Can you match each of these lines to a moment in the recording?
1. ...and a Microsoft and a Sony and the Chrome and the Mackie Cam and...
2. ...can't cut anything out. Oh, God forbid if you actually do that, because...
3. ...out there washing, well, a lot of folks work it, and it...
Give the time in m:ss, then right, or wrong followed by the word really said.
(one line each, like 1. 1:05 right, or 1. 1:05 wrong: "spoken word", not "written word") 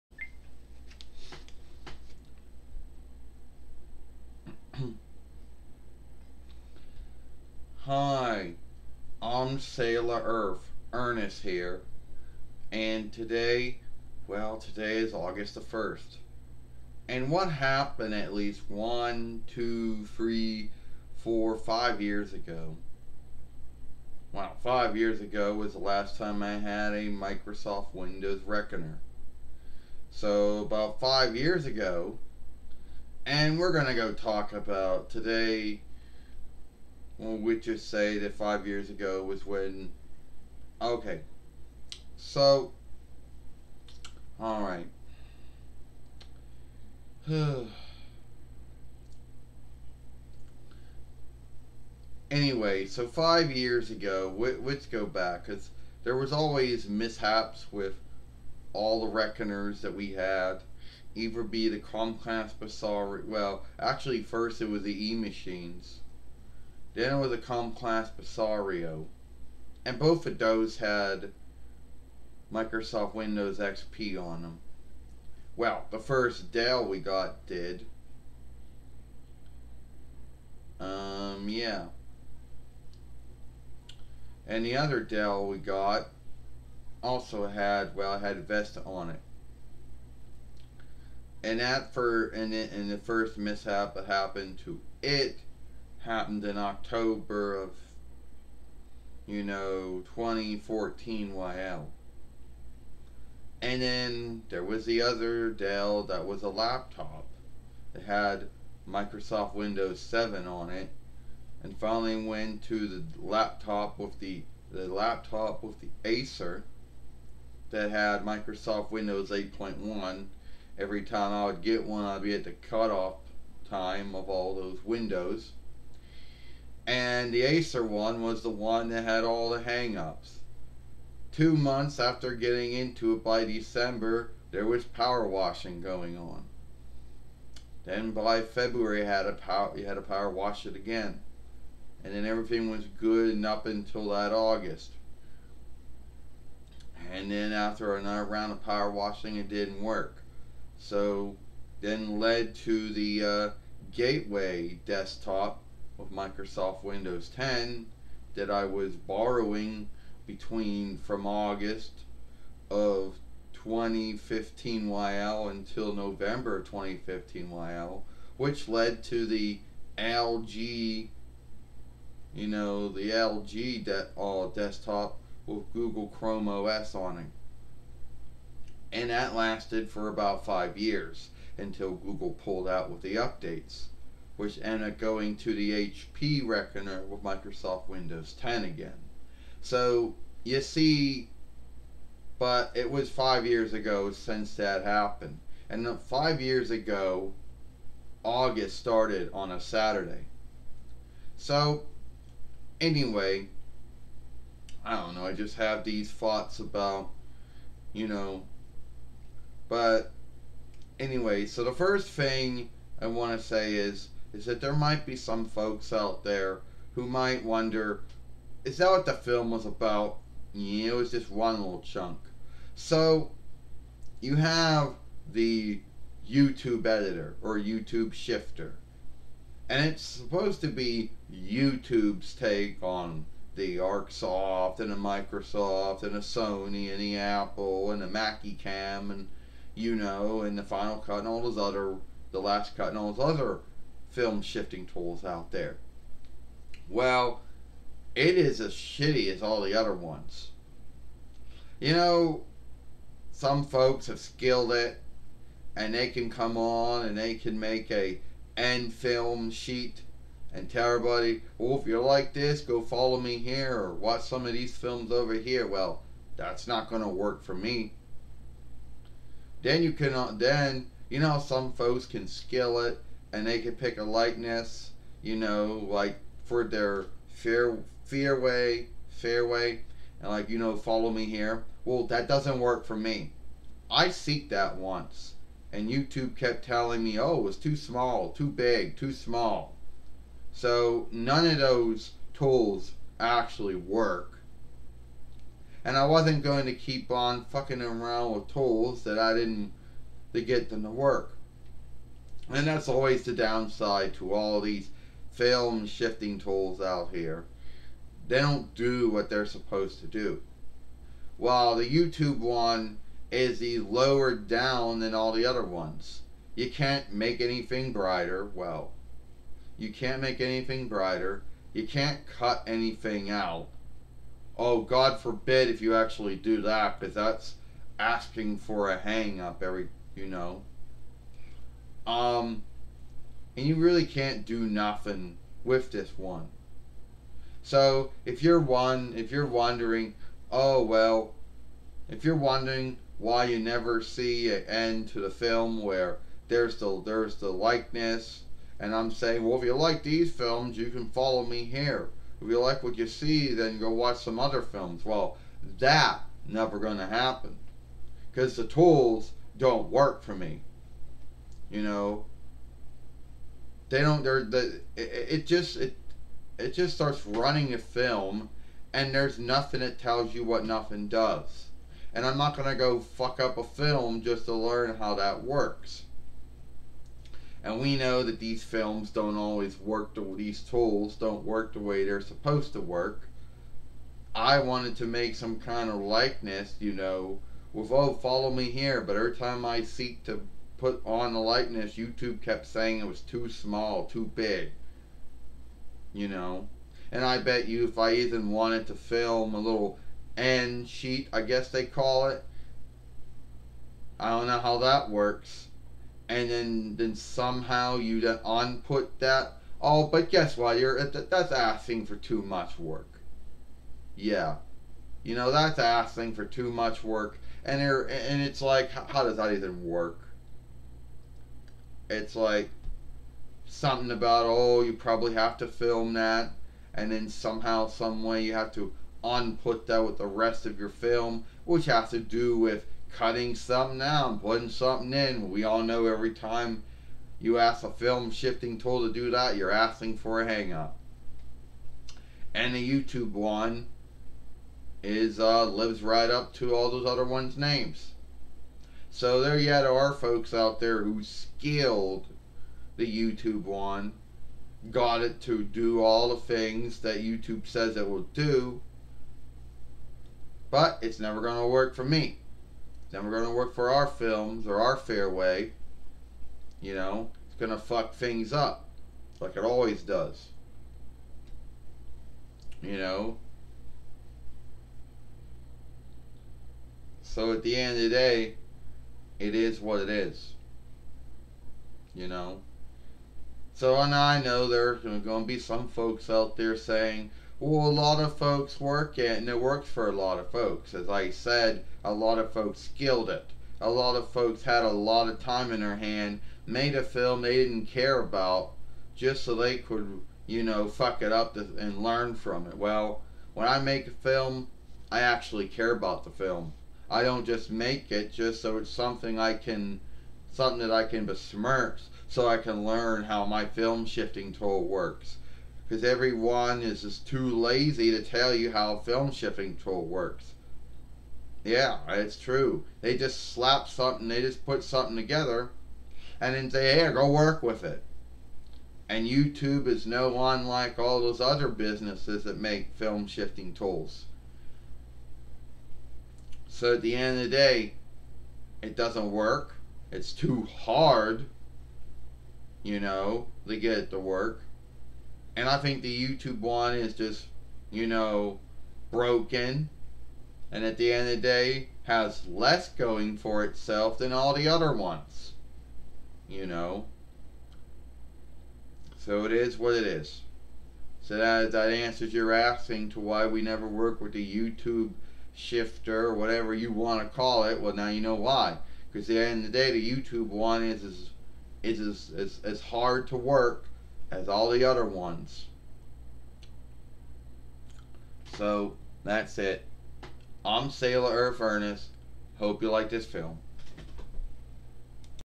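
1. 3:54 wrong: "Apple", not "Chrome"
2. 5:21 right
3. 8:06 wrong: "saying", not "washing".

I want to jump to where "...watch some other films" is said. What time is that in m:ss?
5:53.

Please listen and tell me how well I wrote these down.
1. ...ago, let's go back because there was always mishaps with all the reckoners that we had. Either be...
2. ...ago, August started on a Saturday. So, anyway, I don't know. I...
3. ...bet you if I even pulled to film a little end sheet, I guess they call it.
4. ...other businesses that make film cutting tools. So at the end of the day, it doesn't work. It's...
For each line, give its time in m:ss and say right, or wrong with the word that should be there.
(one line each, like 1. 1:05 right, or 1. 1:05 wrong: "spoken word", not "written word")
1. 0:53 right
2. 3:16 right
3. 6:37 wrong: "wanted", not "pulled"
4. 8:51 wrong: "shifting", not "cutting".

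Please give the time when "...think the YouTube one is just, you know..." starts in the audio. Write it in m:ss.
9:05.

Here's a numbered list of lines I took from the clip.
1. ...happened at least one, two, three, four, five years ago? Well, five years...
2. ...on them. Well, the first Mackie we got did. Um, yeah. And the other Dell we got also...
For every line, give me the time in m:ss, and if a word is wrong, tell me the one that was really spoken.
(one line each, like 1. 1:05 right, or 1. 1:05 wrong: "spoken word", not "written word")
1. 0:17 right
2. 1:14 wrong: "Dell", not "Mackie".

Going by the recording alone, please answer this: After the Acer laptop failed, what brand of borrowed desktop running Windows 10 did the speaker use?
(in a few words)
Gateway.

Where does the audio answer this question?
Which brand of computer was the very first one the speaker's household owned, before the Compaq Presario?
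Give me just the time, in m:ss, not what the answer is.
1:05.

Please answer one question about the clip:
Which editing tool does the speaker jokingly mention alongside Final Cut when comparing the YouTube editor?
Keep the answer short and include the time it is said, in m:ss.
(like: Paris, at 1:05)
the Last Cut, at 4:02.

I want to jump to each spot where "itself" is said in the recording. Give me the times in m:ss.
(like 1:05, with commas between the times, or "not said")
9:13.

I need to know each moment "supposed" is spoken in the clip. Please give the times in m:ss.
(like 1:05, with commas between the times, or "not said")
3:50, 5:09, 6:22.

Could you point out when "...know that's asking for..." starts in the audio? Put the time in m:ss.
6:55.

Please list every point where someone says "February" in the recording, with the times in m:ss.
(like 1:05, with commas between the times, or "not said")
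2:18.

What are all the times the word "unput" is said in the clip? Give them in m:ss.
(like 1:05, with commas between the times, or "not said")
6:48, 7:09.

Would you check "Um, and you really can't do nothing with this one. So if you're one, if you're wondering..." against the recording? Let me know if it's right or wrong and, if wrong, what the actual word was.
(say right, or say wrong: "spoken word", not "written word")
right.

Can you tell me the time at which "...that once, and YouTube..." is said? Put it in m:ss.
4:44.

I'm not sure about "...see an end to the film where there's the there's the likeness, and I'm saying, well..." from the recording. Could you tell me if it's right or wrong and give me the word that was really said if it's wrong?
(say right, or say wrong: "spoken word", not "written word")
right.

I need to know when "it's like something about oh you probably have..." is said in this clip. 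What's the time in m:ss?
7:02.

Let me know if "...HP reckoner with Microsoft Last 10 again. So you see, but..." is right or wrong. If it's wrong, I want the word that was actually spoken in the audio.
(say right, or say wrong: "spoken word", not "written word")
wrong: "Windows", not "Last".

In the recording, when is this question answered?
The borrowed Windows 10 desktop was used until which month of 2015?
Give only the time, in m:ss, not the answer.
2:45.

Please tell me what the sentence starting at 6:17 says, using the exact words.
And we know that these films don't always work.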